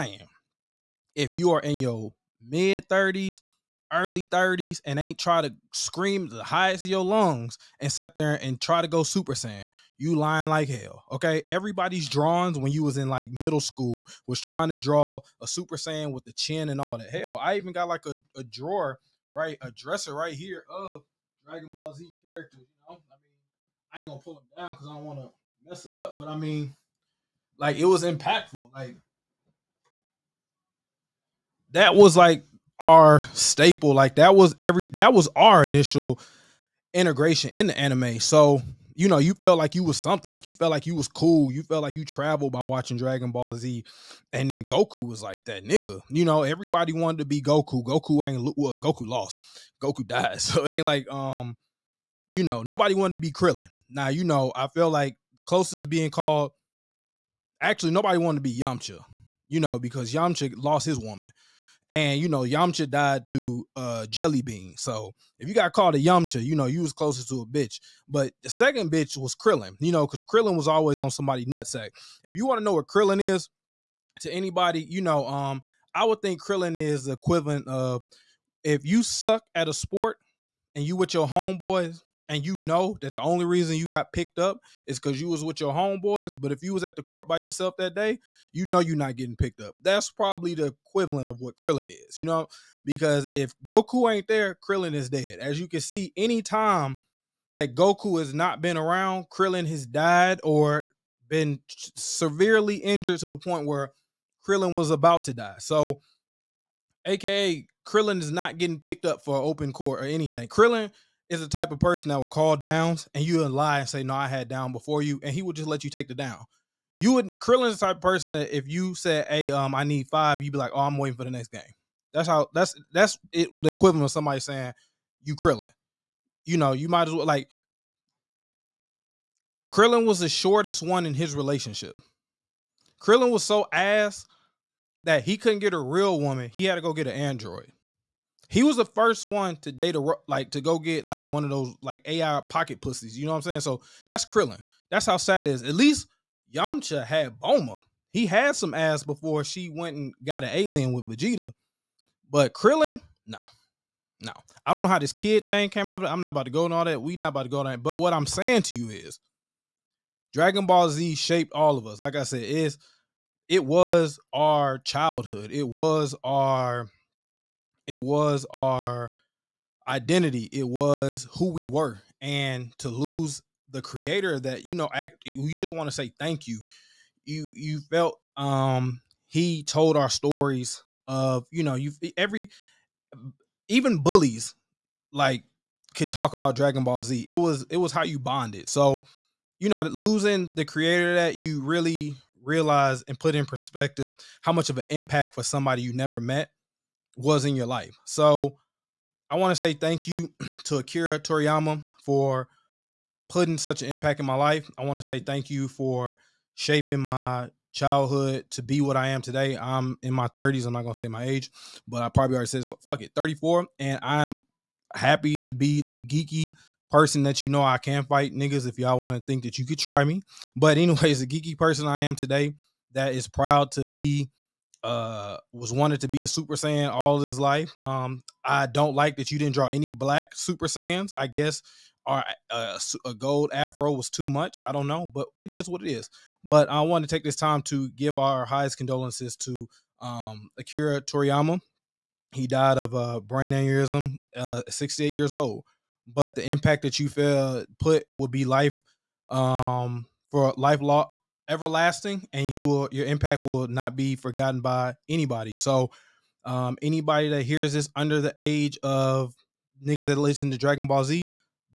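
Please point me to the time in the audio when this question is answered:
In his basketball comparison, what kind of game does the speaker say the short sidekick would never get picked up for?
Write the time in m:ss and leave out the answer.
1:49.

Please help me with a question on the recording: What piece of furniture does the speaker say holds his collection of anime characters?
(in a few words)
Dresser.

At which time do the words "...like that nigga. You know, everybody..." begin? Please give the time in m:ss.
0:45.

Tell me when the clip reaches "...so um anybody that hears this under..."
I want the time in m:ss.
4:15.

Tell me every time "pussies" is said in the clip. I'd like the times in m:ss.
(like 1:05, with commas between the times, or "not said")
2:22.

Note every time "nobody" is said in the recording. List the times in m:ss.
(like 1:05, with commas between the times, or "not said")
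0:52, 0:57.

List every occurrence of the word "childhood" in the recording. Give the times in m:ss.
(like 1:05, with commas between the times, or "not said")
2:44, 3:27.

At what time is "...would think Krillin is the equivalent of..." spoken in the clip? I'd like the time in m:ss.
1:16.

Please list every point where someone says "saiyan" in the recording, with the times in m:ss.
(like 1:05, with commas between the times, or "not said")
0:09, 0:15, 3:46, 3:50.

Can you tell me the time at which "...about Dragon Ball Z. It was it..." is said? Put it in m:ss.
3:06.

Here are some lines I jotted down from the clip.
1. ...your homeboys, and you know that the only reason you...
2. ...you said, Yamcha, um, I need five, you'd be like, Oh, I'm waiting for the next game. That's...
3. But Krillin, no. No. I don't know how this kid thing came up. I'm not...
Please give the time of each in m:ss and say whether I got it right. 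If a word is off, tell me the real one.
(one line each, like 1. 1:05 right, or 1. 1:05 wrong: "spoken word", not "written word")
1. 1:21 right
2. 1:58 wrong: "Hey", not "Yamcha"
3. 2:32 right.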